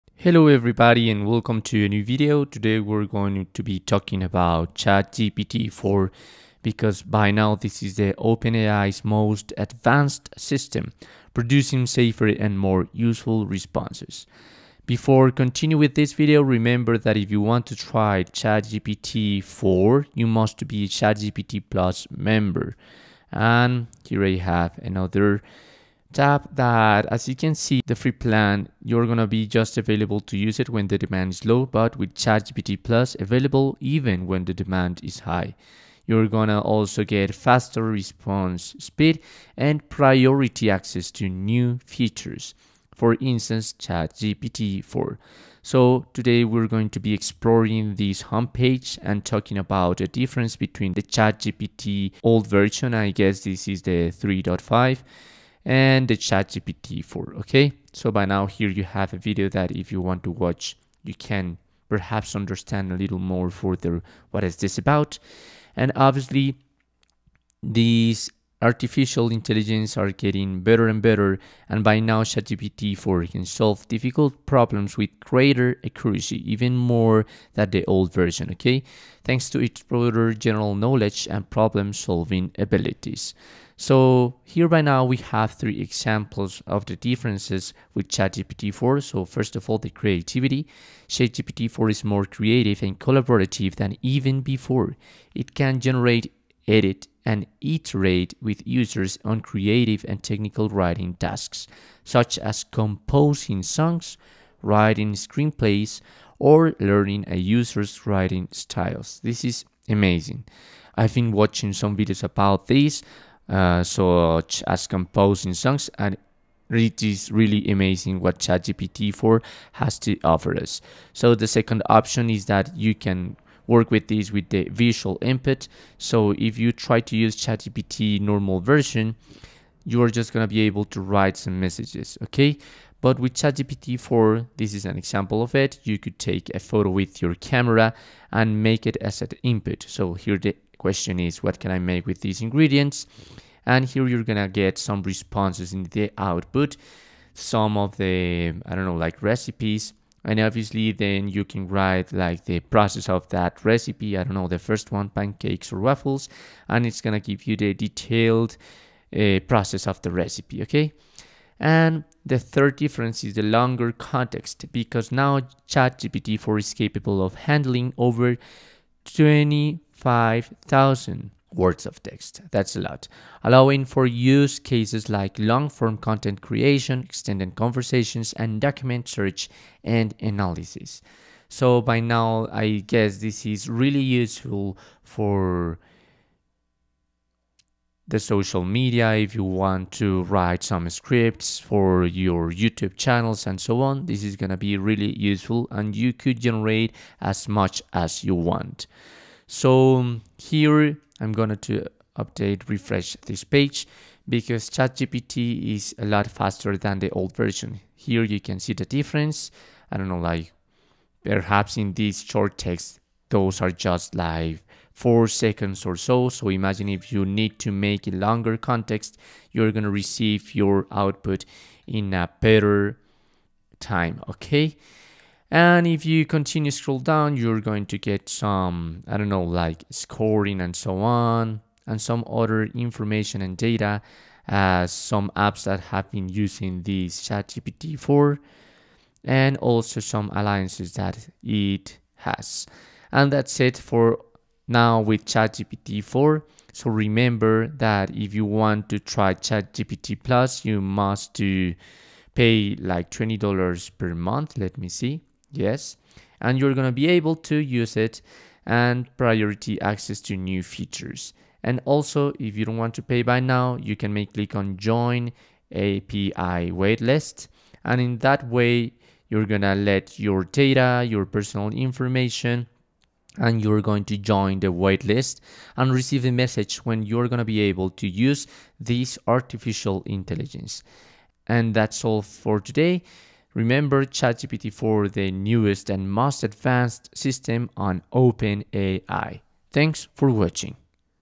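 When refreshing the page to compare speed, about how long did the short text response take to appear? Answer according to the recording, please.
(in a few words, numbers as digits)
four seconds.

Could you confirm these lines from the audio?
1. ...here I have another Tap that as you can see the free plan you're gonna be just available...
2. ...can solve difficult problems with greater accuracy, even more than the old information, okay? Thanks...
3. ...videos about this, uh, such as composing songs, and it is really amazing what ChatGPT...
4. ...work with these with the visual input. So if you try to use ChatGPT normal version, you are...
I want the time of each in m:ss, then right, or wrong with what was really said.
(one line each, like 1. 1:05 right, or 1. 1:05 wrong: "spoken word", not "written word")
1. 0:24 right
2. 1:13 wrong: "version", not "information"
3. 1:51 right
4. 2:03 right.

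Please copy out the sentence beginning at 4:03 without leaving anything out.
And that's it for now with ChatGPT 4.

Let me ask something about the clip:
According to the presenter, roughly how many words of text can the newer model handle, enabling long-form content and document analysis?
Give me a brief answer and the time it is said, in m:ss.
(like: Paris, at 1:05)
over 25,000 words, at 2:47.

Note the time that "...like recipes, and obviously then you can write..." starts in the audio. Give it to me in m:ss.
2:28.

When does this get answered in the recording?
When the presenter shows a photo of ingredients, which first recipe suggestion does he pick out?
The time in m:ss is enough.
2:35.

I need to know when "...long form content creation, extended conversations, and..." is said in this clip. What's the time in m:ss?
2:55.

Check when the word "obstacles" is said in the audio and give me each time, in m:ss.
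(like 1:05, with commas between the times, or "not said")
not said.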